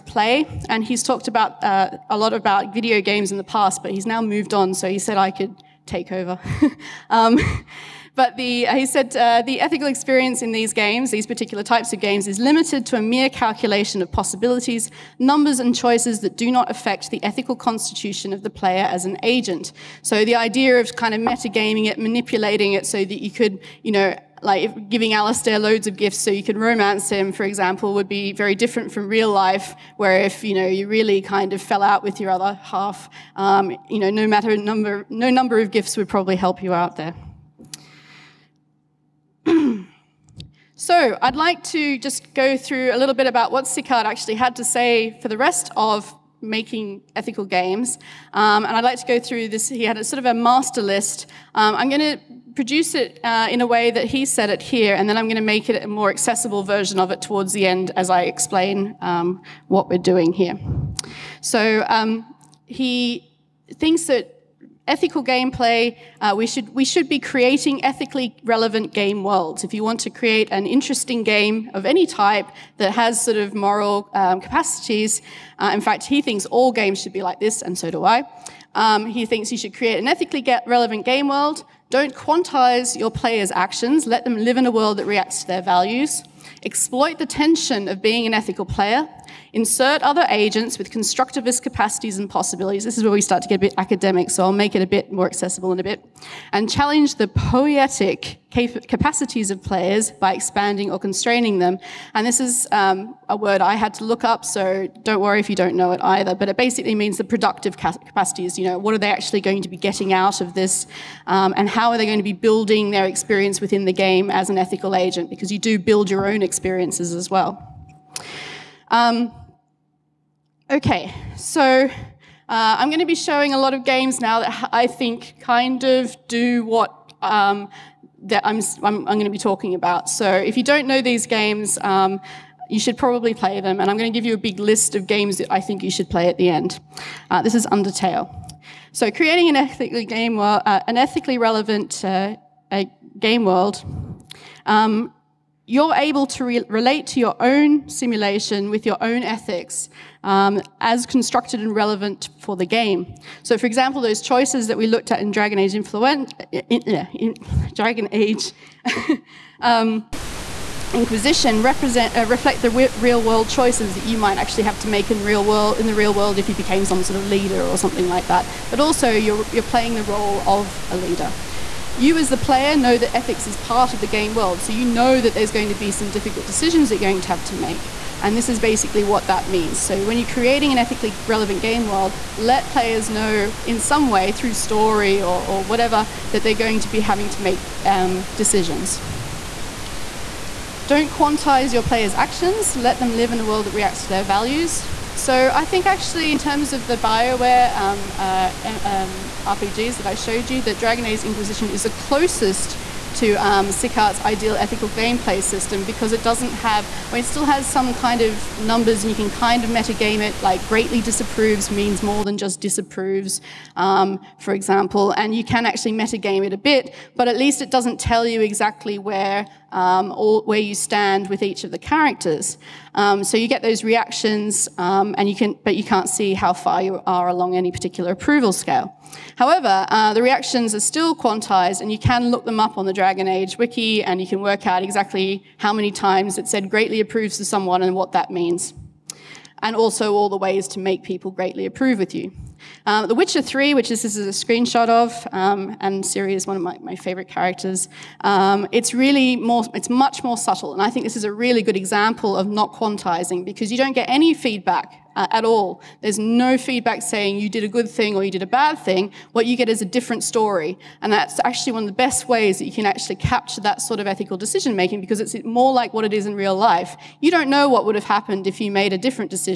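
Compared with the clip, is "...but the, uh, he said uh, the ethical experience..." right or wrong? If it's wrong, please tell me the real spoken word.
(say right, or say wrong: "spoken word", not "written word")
right.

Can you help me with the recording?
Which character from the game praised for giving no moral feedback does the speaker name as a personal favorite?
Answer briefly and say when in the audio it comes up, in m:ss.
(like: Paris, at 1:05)
Ciri, at 4:06.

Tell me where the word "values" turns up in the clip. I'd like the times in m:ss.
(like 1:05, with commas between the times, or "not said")
1:25, 3:14.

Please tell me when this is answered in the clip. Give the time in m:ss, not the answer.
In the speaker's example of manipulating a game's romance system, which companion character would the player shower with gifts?
0:25.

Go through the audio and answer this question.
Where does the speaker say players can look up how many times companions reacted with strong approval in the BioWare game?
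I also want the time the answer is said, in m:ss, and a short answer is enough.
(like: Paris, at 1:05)
Dragon Age wiki, at 3:52.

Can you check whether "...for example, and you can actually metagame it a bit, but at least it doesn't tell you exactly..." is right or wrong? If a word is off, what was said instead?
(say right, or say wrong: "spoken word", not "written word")
right.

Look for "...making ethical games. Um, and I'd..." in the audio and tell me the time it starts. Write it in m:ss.
0:46.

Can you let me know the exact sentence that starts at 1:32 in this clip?
This is where we start to get a bit academic, so I'll make it a bit more accessible in a bit.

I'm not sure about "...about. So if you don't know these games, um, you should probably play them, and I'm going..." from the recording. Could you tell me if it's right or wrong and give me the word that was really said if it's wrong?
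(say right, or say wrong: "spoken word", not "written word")
right.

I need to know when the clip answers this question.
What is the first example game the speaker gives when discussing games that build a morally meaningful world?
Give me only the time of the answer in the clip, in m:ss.
2:17.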